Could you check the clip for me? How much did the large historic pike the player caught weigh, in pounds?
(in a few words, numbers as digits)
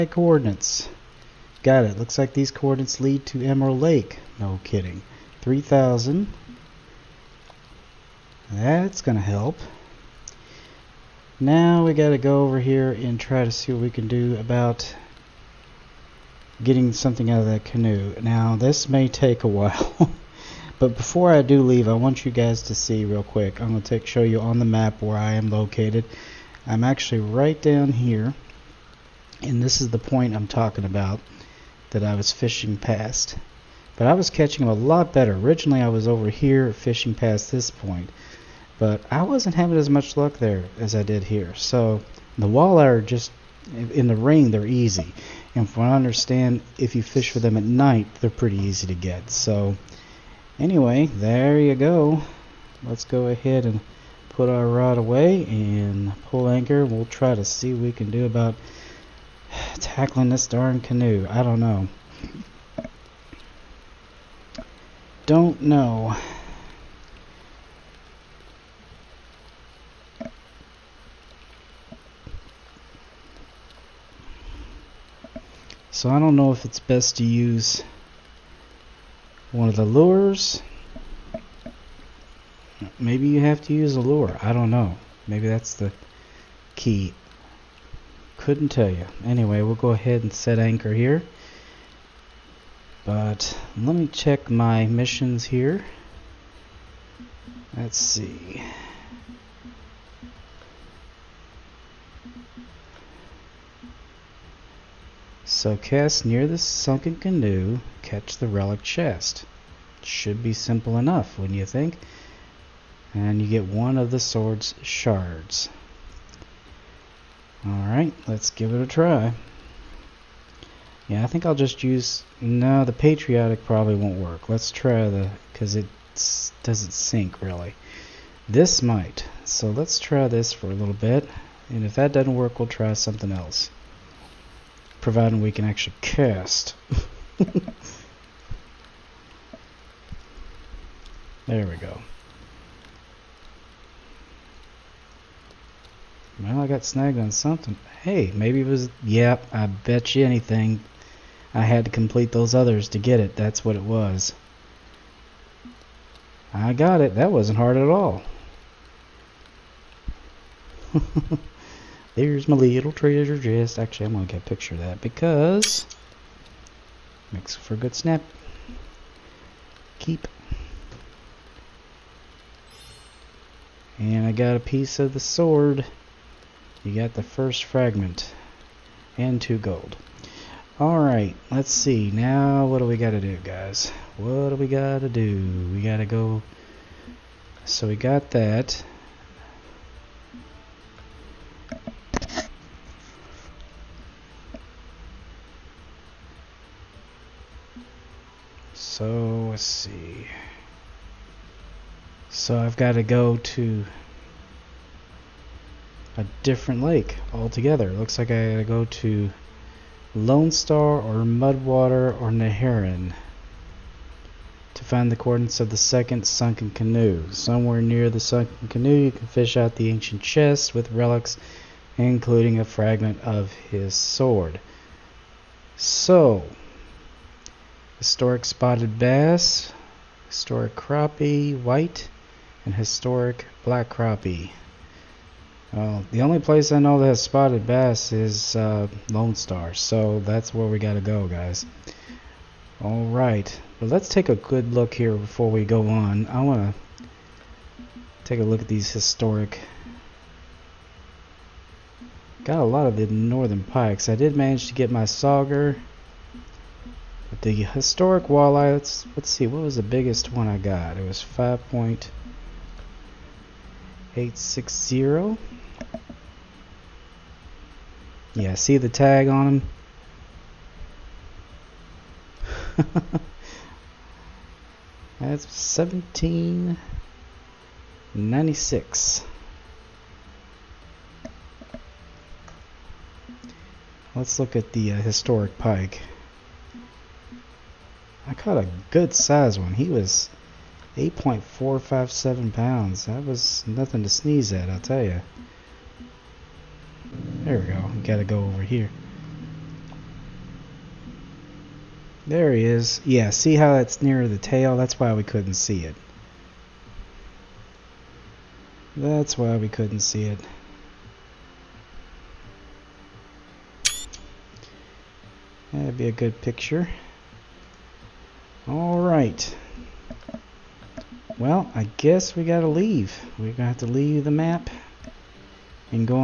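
8.457 pounds.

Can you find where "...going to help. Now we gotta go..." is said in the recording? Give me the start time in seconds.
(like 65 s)
8 s.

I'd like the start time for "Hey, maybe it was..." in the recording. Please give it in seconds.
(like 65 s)
148 s.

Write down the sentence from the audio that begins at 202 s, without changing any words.
So I've got to go to a different lake altogether.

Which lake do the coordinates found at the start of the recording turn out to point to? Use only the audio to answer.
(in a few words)
Emerald Lake.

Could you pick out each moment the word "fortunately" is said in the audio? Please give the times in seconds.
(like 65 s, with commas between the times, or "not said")
not said.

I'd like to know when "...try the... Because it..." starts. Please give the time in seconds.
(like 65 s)
124 s.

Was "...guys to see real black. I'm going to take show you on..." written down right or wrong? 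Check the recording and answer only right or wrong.
wrong.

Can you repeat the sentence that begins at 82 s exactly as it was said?
Maybe you have to use a lure.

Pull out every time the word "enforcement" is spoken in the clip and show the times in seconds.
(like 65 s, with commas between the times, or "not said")
not said.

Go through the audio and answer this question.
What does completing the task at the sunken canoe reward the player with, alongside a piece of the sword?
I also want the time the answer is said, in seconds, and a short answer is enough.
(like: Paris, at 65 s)
2 gold, at 179 s.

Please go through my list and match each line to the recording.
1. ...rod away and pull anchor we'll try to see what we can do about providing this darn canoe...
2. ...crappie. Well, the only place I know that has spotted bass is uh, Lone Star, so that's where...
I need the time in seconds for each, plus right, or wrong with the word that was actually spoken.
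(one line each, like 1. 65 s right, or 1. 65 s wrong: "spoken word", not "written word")
1. 54 s wrong: "tackling", not "providing"
2. 233 s right.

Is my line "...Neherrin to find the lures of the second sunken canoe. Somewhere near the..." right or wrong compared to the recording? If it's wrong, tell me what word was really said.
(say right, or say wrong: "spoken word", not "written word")
wrong: "coordinates", not "lures".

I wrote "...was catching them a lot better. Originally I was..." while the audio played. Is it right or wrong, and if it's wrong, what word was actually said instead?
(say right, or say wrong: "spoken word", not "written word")
right.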